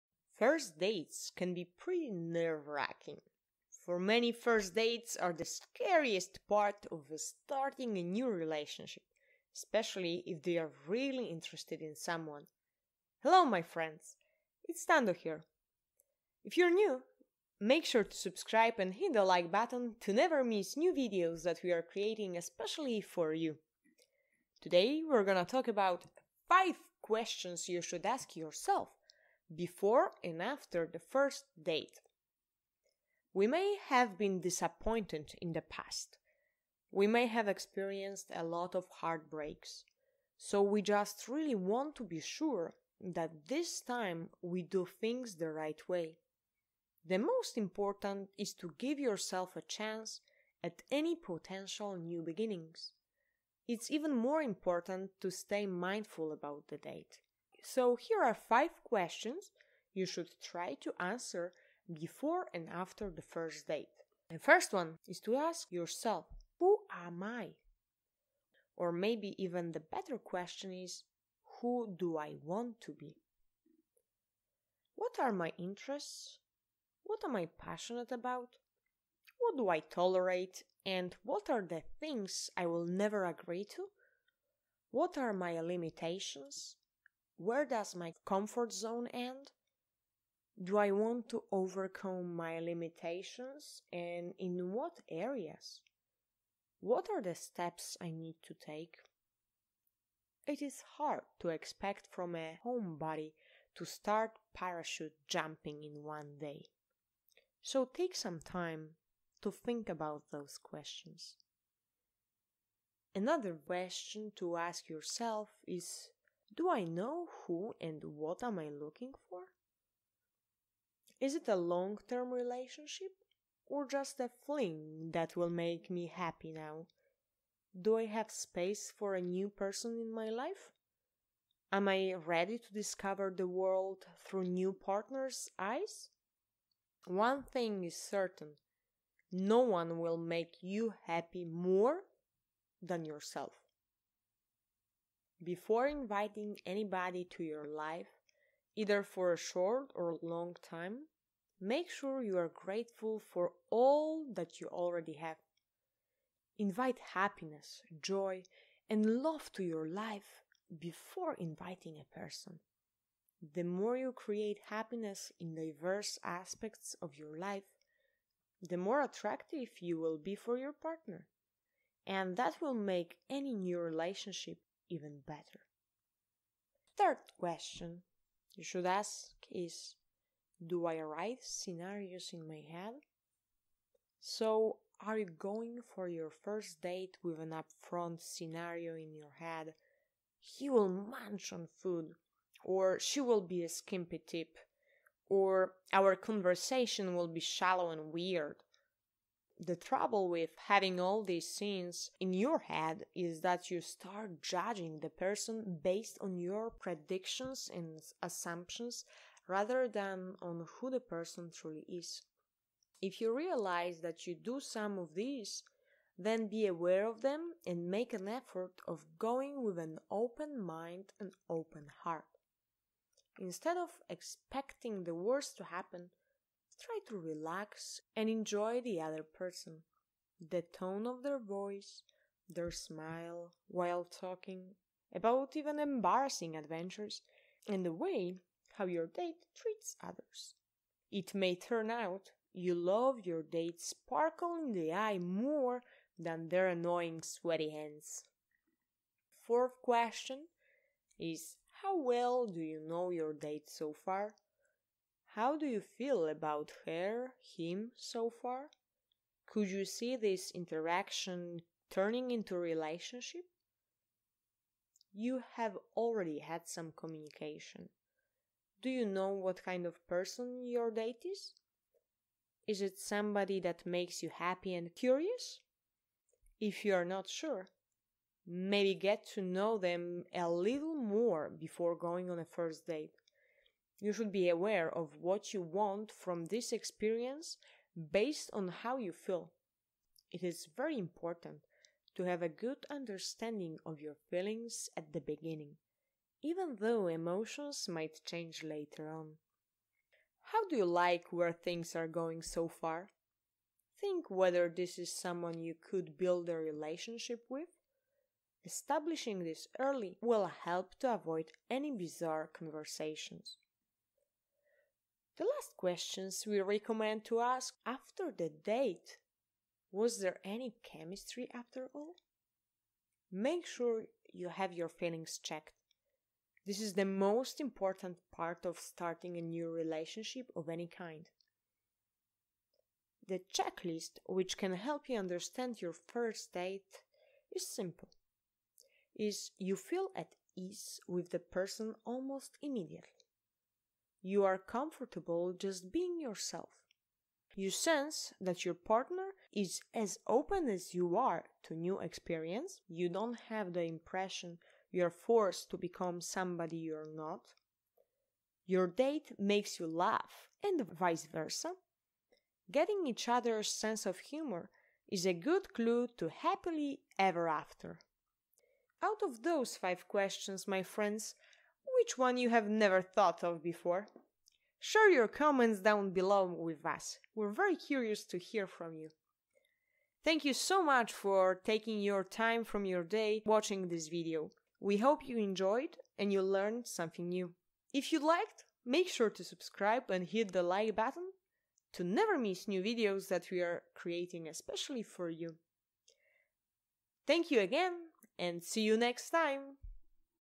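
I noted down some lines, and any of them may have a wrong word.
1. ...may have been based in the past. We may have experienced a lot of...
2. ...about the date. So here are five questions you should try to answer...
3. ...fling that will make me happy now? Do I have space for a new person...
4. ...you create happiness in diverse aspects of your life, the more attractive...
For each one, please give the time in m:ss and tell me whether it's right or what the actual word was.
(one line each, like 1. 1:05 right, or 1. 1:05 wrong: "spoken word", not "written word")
1. 0:33 wrong: "disappointed", not "based"
2. 0:56 right
3. 2:04 right
4. 2:43 right.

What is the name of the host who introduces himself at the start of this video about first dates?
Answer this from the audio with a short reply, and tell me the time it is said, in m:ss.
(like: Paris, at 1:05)
Stando, at 0:14.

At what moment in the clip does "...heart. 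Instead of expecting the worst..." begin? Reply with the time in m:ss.
3:42.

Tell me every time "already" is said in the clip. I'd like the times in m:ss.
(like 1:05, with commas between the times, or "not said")
2:34, 4:25.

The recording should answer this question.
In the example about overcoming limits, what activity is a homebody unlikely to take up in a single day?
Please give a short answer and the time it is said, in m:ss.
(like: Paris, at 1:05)
parachute jumping, at 1:44.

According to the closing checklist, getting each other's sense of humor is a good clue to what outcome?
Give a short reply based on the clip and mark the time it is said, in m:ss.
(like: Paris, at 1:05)
happily ever after, at 6:06.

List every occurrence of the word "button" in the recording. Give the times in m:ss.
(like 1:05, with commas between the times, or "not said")
0:19, 6:30.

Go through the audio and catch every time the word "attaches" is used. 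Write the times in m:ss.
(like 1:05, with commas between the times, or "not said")
not said.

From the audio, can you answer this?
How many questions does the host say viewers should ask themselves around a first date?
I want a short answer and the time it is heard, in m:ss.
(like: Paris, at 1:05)
5, at 0:26.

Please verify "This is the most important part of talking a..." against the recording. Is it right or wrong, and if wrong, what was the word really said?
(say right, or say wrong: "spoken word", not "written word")
wrong: "starting", not "talking".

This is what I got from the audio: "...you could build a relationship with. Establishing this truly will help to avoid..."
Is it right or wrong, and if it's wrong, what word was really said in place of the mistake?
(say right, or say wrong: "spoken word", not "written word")
wrong: "early", not "truly".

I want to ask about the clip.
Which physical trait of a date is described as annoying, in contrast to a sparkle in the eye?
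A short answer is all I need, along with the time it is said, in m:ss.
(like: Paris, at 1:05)
sweaty hands, at 4:07.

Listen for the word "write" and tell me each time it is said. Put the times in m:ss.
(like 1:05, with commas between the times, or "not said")
3:01.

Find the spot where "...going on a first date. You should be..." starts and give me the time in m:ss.
4:41.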